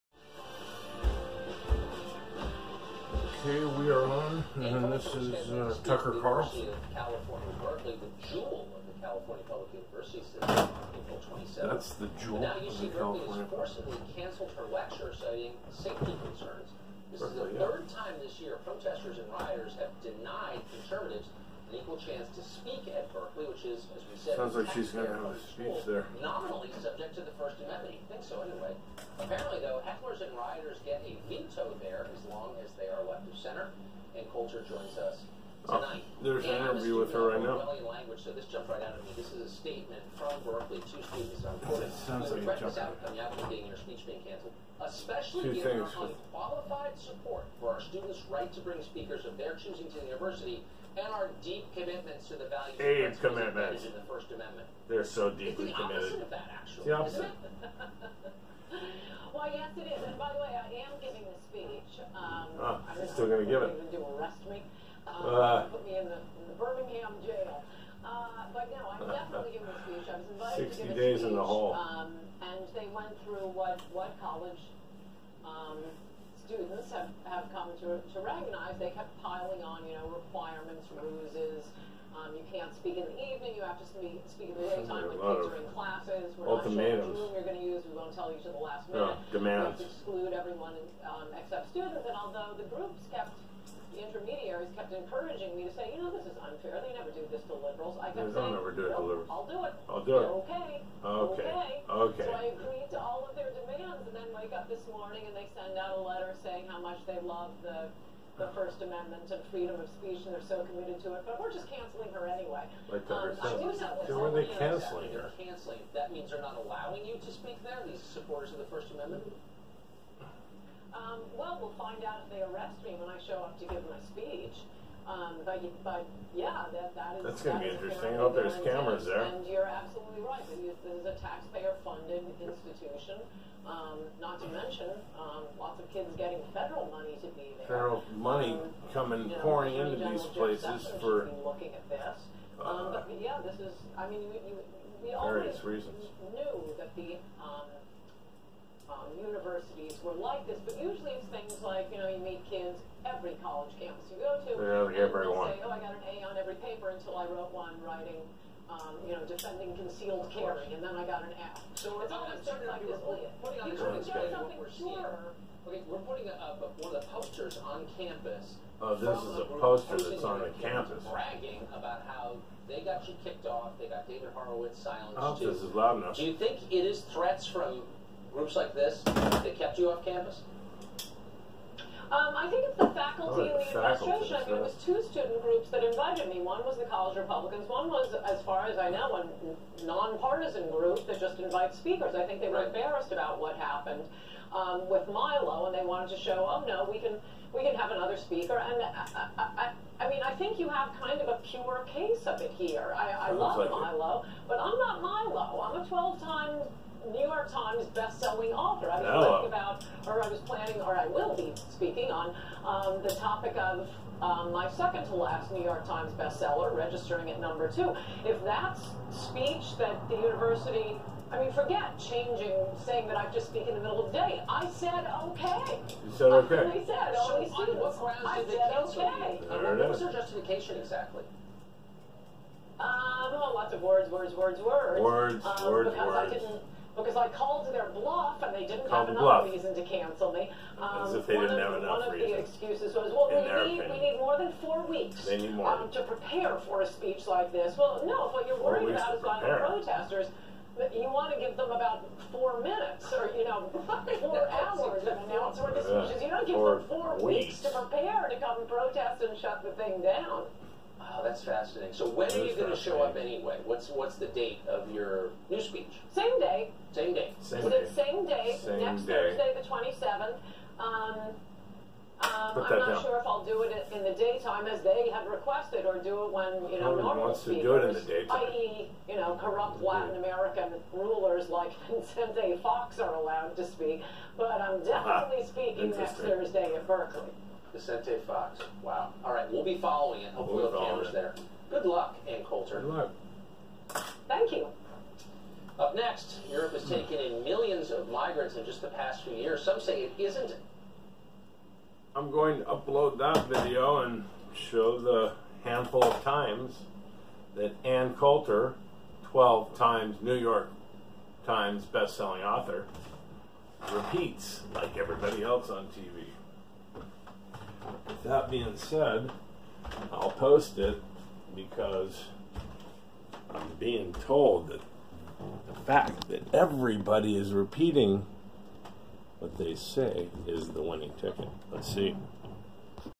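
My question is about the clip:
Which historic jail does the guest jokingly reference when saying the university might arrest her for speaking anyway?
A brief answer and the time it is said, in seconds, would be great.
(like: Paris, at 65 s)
Birmingham jail, at 66 s.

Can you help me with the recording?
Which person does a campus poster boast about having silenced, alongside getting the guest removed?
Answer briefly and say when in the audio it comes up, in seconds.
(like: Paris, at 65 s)
David Horowitz, at 174 s.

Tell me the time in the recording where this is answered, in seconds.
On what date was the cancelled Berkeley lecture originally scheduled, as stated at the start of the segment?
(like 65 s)
10 s.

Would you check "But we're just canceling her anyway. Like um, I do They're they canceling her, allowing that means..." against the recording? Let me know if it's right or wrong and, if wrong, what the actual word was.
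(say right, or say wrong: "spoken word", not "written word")
wrong: "canceling", not "allowing".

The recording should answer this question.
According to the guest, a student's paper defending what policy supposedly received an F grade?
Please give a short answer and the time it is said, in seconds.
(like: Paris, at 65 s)
concealed carry, at 159 s.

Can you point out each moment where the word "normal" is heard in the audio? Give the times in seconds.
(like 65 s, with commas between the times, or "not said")
277 s.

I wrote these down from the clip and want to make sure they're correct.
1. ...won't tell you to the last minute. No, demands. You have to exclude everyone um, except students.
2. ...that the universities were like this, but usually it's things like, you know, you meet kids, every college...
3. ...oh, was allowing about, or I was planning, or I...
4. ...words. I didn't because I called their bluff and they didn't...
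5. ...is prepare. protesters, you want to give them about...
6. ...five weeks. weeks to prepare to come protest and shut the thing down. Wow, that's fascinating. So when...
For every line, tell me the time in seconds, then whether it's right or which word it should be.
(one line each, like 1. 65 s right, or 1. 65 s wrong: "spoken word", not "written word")
1. 87 s right
2. 146 s right
3. 209 s wrong: "talking", not "allowing"
4. 236 s right
5. 249 s right
6. 256 s wrong: "four", not "five".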